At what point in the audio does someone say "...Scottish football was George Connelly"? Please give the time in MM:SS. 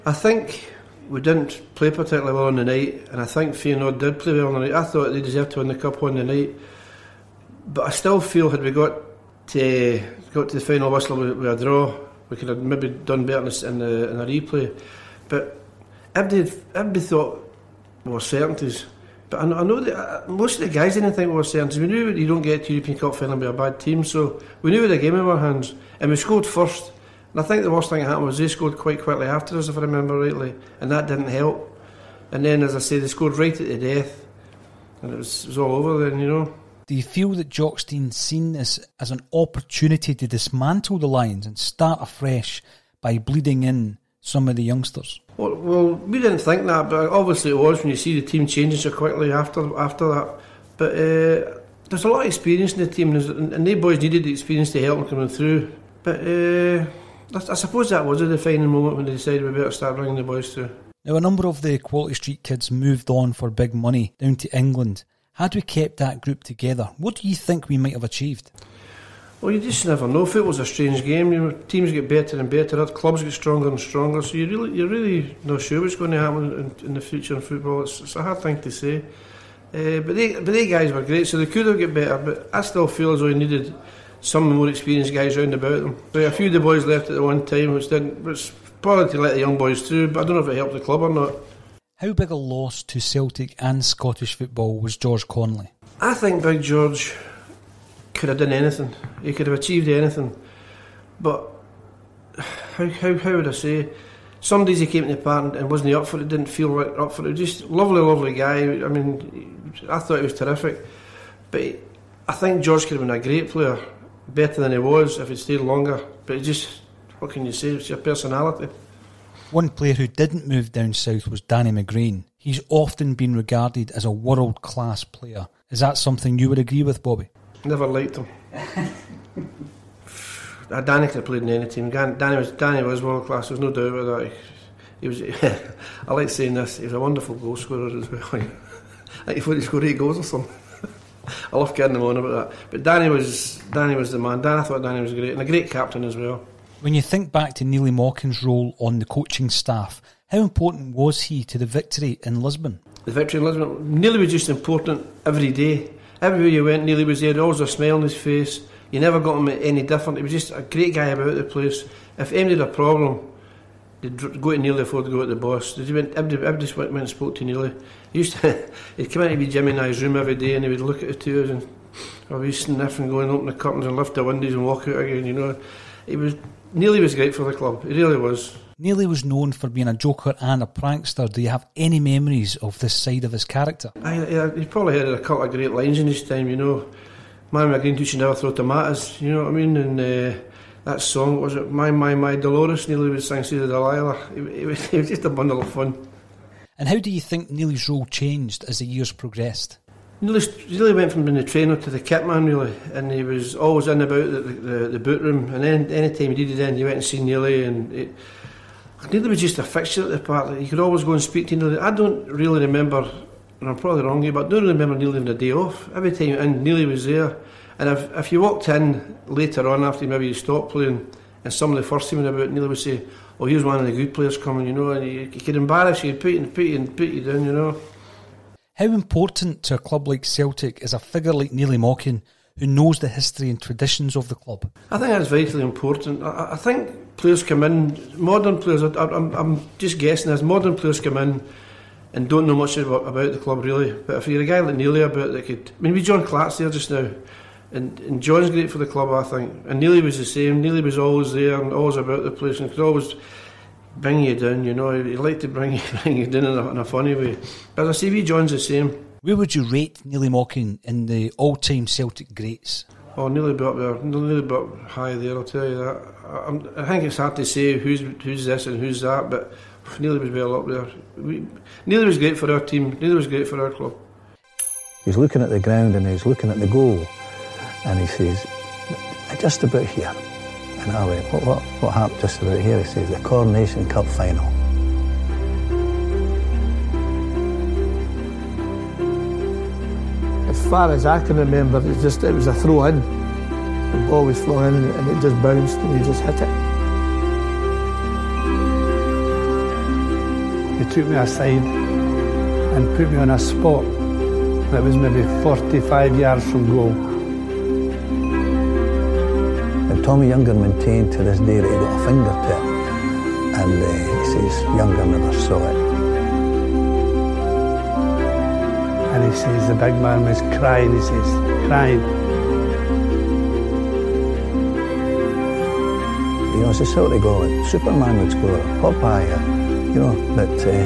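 01:33.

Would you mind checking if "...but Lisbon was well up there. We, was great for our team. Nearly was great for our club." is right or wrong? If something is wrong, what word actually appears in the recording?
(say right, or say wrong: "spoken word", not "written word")
wrong: "Nearly", not "Lisbon".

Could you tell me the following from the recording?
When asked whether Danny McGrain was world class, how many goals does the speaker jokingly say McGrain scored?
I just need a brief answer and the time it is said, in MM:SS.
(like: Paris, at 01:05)
8, at 02:19.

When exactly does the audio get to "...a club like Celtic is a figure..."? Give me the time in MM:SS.
03:49.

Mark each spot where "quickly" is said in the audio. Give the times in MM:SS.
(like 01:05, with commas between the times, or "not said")
00:28, 00:48.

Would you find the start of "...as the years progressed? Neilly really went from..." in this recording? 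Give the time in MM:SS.
03:18.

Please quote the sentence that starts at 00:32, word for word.
And then, as I say, they scored right at the death, and it was, it was all over then, you know.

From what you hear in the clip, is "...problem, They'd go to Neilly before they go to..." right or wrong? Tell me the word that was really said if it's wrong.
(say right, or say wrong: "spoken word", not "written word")
right.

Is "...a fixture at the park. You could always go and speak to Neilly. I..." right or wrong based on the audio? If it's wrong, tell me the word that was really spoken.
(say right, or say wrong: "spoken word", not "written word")
right.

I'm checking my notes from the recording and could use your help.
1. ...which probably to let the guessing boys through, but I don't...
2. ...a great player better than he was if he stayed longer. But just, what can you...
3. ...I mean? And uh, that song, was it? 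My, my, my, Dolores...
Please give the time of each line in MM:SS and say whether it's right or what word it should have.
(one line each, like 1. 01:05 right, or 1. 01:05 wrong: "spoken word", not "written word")
1. 01:28 wrong: "young", not "guessing"
2. 01:53 right
3. 03:09 right.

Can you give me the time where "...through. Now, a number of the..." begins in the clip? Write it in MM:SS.
01:00.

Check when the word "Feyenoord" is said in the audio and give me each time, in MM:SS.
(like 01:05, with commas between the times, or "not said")
00:03.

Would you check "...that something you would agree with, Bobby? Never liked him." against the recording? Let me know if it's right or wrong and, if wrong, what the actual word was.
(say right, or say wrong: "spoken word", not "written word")
right.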